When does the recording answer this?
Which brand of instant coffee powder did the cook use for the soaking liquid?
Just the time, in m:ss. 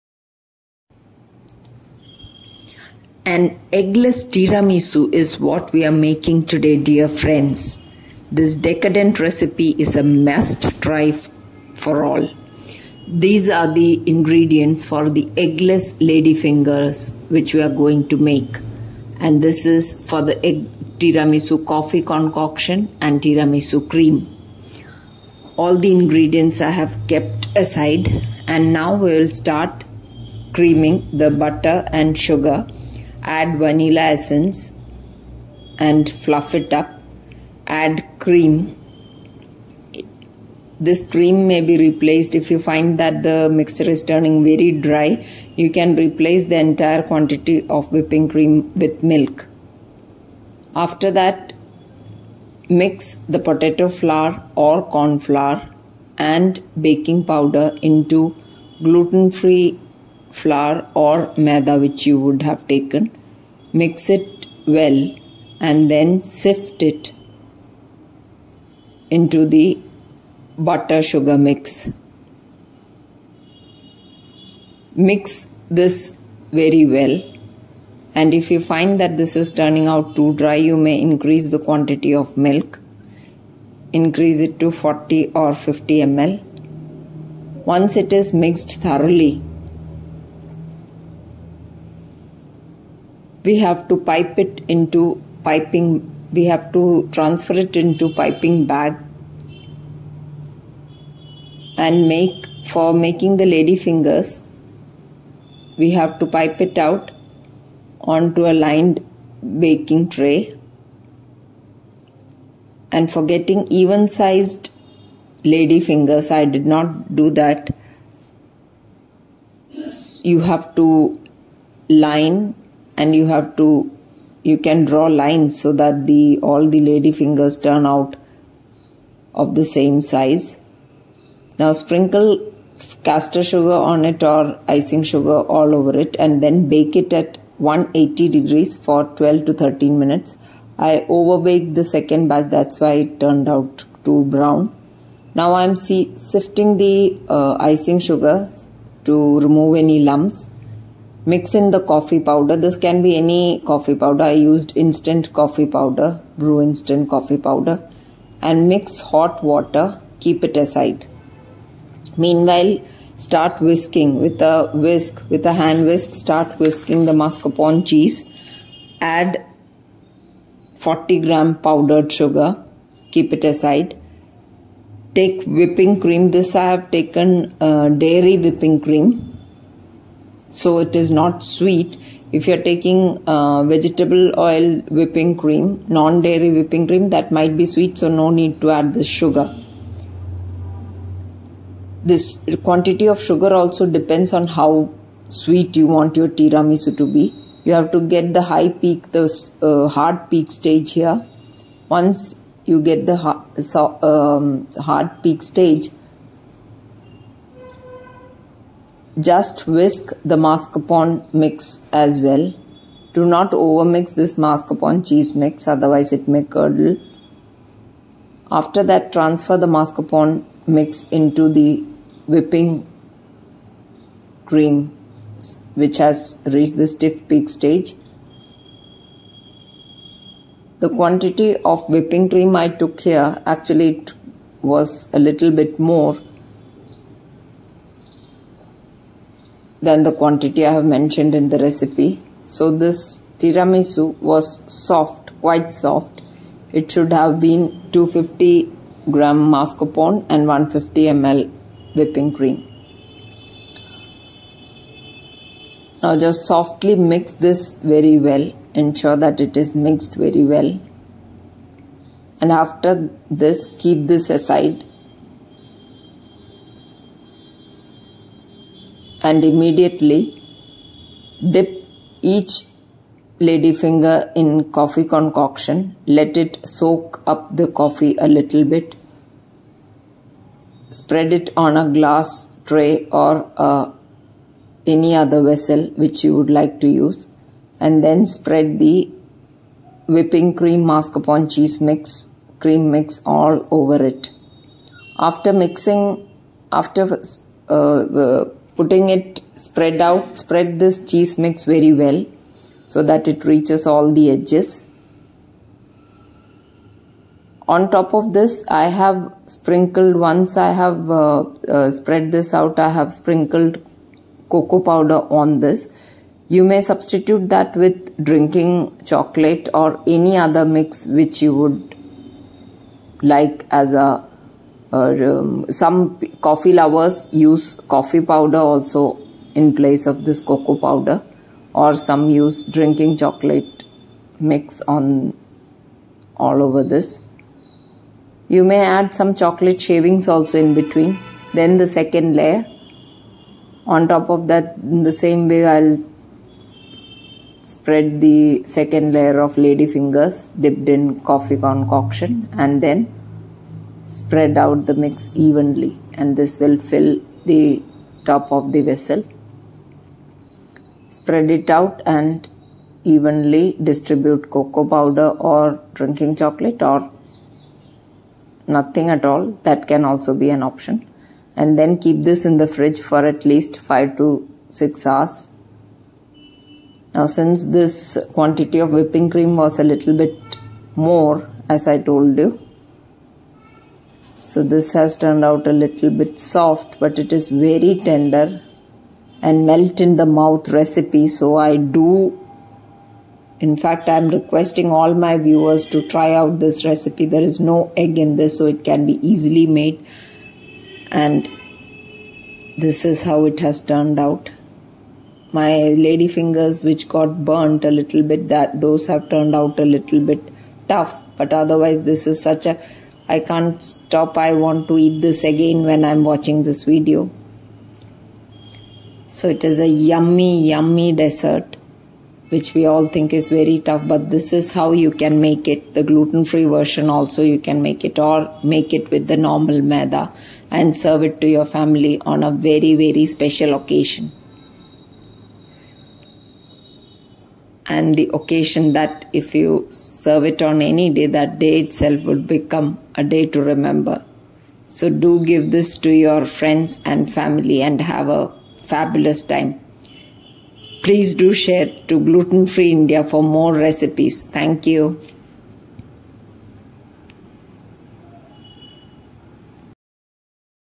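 2:36.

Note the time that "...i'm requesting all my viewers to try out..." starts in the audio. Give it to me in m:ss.
6:34.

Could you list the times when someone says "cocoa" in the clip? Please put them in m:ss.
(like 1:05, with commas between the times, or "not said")
5:14, 5:30, 6:04.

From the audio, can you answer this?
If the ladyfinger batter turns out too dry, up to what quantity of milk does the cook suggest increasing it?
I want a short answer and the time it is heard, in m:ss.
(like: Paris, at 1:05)
40 or 50 ml, at 1:24.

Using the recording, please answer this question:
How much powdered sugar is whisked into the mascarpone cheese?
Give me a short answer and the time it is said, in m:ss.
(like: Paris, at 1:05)
40 gram, at 2:50.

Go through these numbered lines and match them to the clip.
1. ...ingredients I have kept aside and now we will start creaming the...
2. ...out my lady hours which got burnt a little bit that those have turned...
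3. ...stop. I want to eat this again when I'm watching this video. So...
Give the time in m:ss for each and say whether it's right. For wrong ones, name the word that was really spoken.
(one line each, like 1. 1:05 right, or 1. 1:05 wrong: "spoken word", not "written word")
1. 0:25 right
2. 6:44 wrong: "fingers", not "hours"
3. 6:53 right.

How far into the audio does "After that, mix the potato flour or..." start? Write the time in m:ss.
0:50.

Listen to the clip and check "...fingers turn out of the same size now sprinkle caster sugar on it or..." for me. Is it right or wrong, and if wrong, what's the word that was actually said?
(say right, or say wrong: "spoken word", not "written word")
right.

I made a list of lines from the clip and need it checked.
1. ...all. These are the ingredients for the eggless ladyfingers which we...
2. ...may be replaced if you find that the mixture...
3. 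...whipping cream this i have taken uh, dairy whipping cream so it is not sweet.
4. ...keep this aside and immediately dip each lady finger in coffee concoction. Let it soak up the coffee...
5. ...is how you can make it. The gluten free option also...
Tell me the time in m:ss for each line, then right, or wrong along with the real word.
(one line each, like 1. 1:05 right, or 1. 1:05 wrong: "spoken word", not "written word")
1. 0:12 right
2. 0:41 right
3. 2:55 right
4. 4:23 right
5. 7:04 wrong: "version", not "option".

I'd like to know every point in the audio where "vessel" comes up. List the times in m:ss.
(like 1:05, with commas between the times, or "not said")
4:45, 5:58.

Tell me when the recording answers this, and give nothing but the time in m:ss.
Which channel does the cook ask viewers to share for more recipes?
7:32.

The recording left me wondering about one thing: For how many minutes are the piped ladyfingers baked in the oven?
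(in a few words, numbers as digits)
12 to 13 minutes.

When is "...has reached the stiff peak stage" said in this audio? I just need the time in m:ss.
3:45.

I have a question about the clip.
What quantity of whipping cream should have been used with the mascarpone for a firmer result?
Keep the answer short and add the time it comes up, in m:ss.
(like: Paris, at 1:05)
150 ml, at 4:10.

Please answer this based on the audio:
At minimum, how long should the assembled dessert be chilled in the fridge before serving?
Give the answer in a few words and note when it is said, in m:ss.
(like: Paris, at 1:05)
5 to 6 hours, at 6:13.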